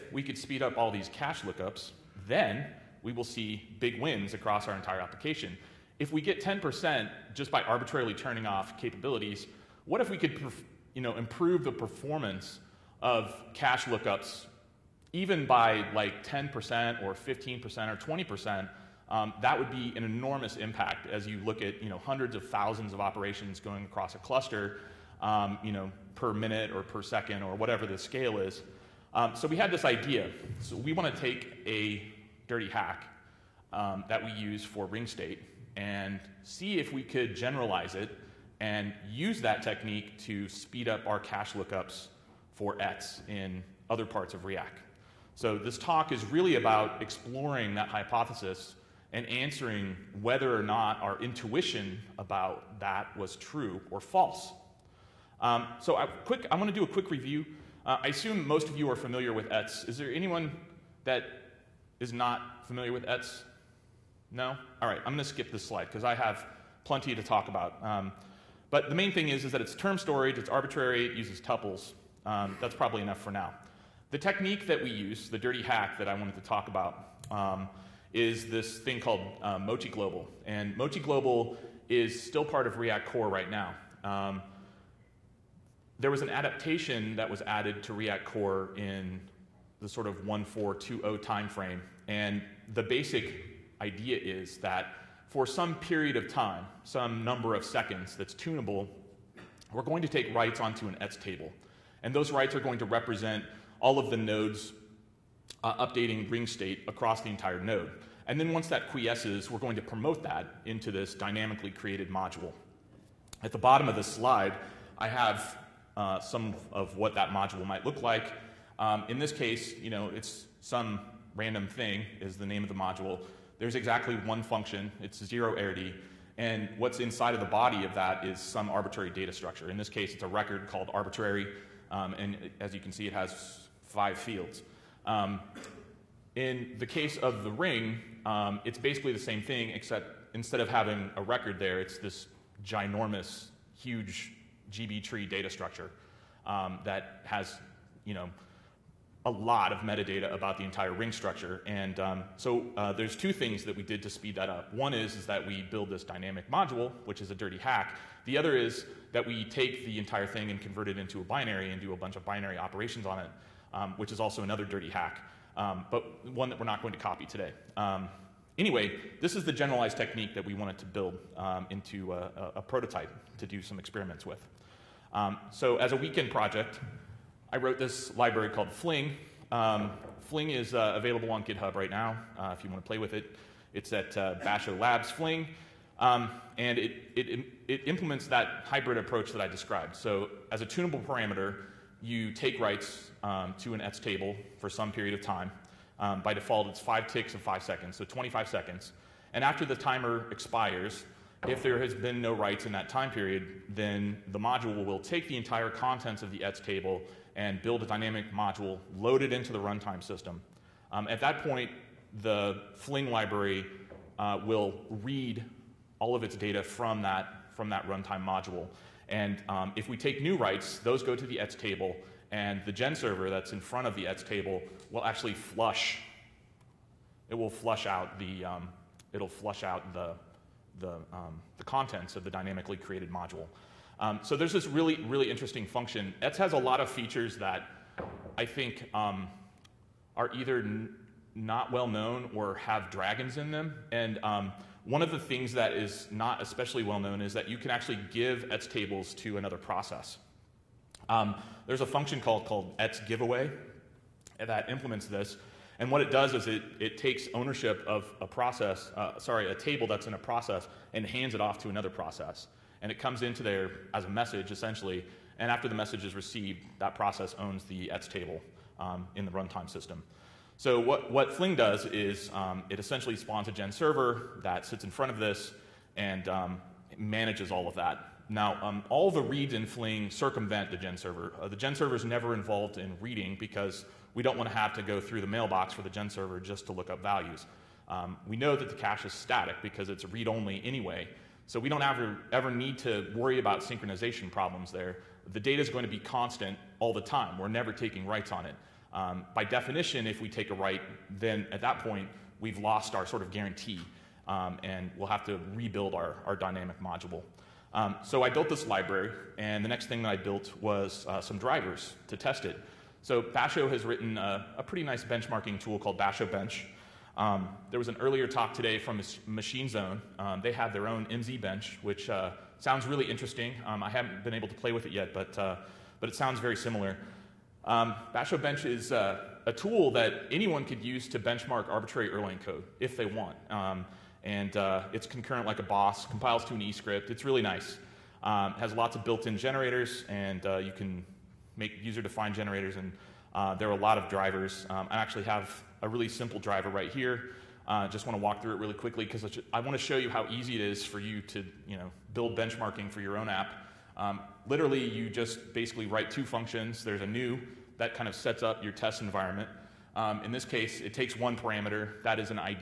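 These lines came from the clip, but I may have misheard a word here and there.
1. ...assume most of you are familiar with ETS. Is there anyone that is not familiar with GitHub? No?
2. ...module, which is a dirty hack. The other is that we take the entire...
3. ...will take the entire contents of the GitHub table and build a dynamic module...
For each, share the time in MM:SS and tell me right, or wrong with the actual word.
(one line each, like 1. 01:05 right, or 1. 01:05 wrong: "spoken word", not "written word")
1. 00:58 wrong: "ETS", not "GitHub"
2. 02:36 right
3. 03:24 wrong: "ETS", not "GitHub".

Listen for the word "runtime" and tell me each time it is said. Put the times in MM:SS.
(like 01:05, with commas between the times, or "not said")
03:29, 03:37, 04:29.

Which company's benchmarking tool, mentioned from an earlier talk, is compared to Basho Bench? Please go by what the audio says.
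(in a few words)
Machine Zone.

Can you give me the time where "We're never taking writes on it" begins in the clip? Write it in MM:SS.
04:57.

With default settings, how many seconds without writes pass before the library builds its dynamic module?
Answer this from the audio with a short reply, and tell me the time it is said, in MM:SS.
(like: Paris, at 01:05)
25 seconds, at 03:18.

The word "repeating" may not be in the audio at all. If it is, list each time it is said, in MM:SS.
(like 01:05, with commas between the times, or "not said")
not said.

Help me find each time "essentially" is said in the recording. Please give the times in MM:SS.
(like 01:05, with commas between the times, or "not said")
04:24, 04:32.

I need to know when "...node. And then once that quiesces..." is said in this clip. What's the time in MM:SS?
01:47.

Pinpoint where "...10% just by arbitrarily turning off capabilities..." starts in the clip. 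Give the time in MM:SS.
00:06.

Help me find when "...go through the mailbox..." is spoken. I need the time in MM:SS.
04:44.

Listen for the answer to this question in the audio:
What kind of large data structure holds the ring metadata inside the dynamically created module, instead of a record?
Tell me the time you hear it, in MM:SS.
02:24.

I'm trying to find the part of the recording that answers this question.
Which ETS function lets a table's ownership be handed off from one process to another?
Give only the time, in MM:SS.
04:12.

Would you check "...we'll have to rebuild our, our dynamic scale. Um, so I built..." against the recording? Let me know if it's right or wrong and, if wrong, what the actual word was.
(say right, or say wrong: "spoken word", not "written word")
wrong: "module", not "scale".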